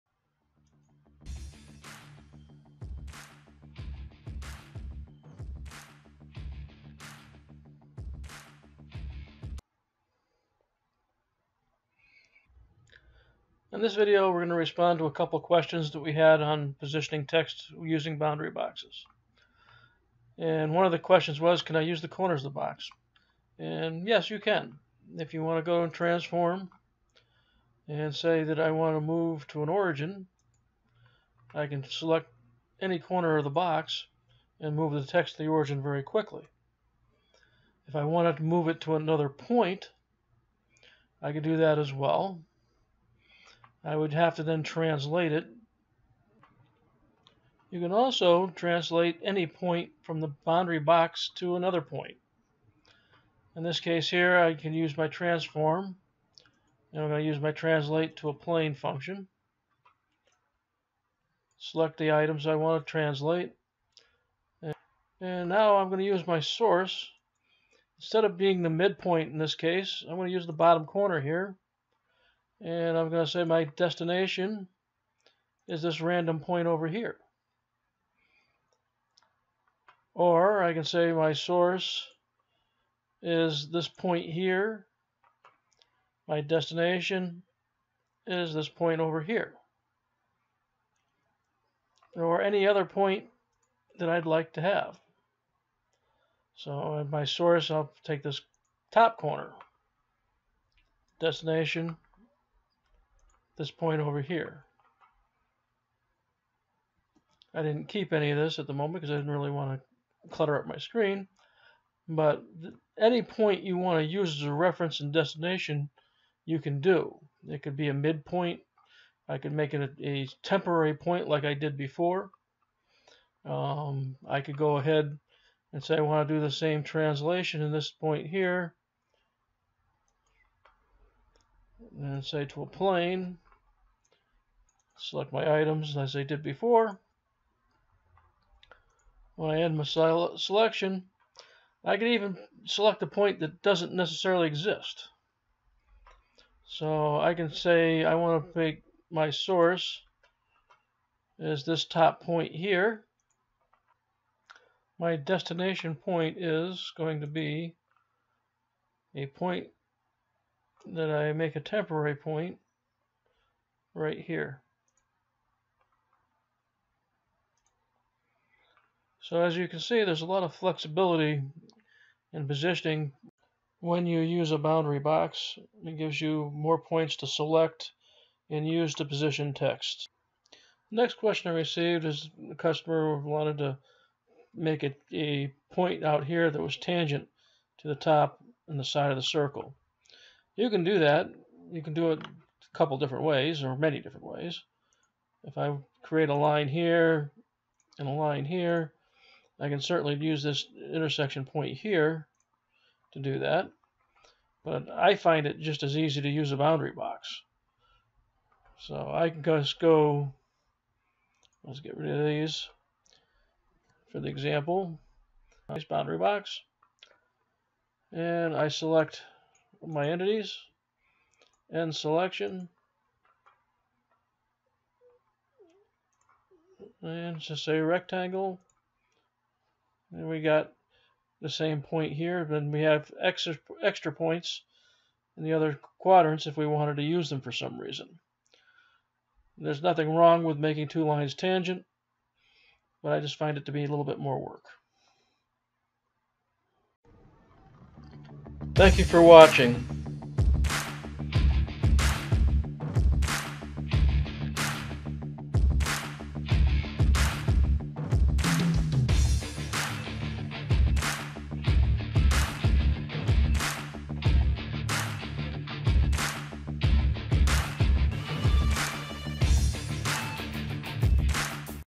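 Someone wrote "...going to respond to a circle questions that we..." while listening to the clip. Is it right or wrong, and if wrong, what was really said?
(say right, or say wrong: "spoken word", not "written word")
wrong: "couple", not "circle".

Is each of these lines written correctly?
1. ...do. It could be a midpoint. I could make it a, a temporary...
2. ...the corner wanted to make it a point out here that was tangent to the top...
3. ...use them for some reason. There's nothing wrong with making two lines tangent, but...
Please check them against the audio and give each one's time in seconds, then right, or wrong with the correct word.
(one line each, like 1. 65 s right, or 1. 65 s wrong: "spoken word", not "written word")
1. 116 s right
2. 182 s wrong: "customer", not "corner"
3. 237 s right.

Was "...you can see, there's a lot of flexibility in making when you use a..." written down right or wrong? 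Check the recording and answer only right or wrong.
wrong.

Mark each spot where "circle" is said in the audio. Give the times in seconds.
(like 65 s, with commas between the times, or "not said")
189 s.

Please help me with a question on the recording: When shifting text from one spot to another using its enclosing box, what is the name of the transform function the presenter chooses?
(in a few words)
translate to a plane.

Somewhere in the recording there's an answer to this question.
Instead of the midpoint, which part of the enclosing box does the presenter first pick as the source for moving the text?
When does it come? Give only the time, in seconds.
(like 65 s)
70 s.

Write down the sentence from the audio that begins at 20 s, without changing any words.
And one of the questions was, can I use the corners of the box?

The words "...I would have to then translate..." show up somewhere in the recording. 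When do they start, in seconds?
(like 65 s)
43 s.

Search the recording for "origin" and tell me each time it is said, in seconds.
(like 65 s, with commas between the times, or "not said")
29 s, 35 s.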